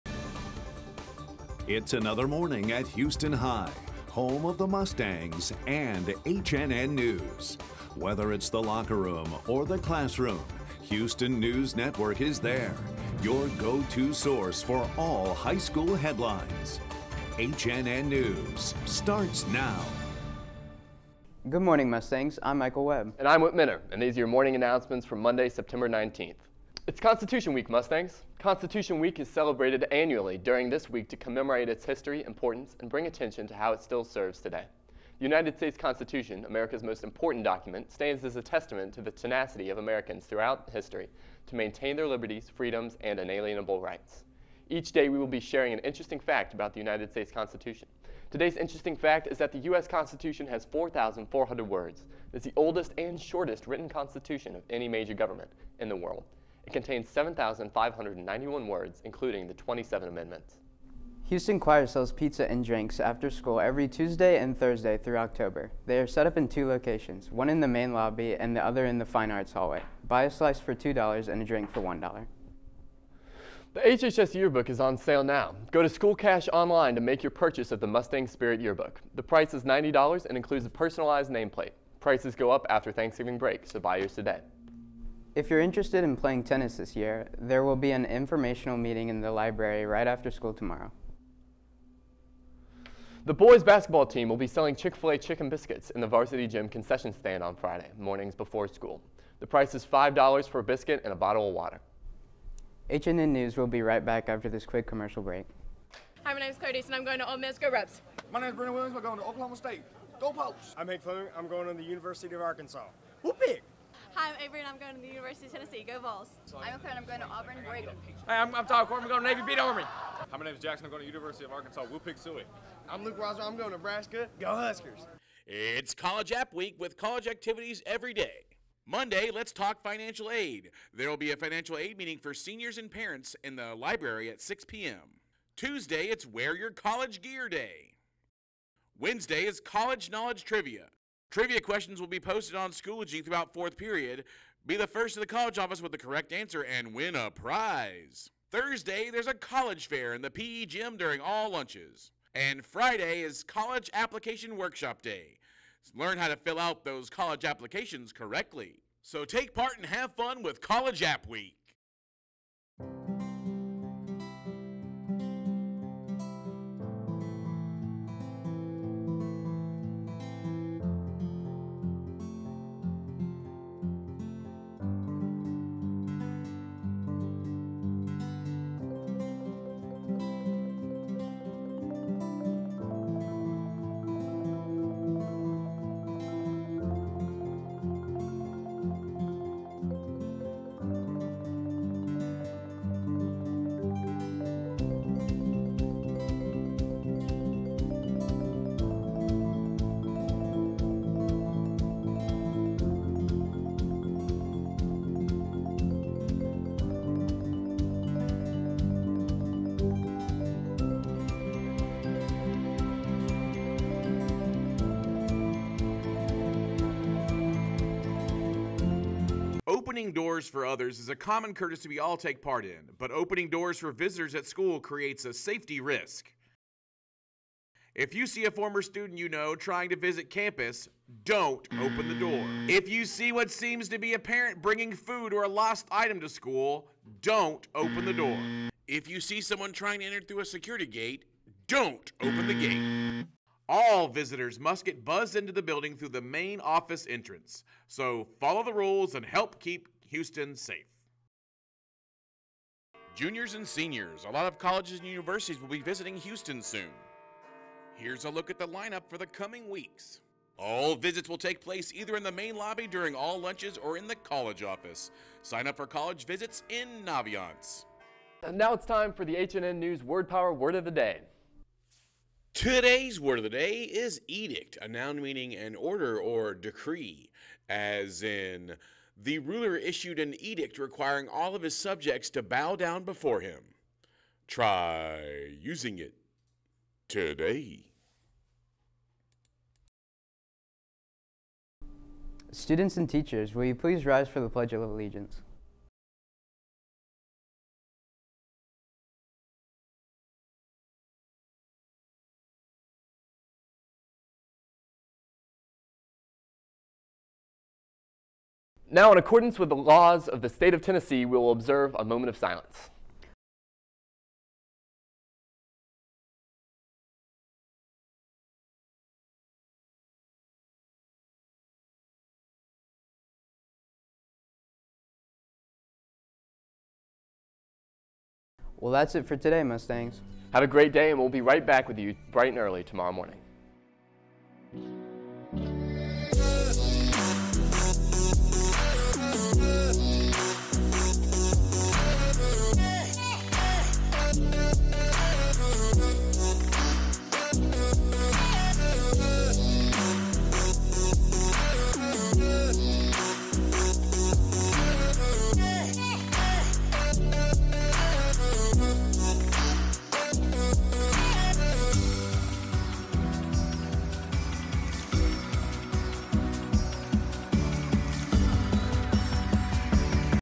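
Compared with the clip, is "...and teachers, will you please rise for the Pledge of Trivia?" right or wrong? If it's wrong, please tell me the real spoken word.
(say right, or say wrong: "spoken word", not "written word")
wrong: "Allegiance", not "Trivia".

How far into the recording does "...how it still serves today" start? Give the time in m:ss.
0:33.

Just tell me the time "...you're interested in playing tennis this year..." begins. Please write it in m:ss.
1:25.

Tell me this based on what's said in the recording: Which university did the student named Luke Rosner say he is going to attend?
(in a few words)
Nebraska.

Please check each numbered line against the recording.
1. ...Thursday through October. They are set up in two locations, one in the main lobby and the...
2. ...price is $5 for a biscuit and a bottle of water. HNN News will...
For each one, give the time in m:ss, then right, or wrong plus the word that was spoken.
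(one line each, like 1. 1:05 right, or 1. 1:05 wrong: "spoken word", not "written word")
1. 1:04 right
2. 1:39 right.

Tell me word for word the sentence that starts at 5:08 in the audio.
Now, in accordance with the laws of the state of Tennessee, we will observe a moment of silence.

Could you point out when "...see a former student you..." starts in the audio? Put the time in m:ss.
3:48.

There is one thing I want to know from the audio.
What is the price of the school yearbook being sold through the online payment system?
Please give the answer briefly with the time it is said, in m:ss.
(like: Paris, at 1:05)
$90, at 1:19.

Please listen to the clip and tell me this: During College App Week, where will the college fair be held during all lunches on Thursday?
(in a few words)
PE gym.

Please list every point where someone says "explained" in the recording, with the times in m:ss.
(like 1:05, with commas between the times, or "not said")
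not said.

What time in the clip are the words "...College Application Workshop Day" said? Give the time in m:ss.
2:33.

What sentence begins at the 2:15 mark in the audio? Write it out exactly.
Tuesday, it's Wear Your College Gear Day.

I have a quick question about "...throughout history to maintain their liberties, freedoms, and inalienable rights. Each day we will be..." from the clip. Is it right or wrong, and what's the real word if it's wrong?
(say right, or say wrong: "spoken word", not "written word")
right.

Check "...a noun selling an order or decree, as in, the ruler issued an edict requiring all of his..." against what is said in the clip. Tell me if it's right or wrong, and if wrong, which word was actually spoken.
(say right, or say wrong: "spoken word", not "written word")
wrong: "meaning", not "selling".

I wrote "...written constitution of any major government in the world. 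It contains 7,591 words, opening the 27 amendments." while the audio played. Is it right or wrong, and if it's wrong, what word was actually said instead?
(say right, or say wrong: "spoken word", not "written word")
wrong: "including", not "opening".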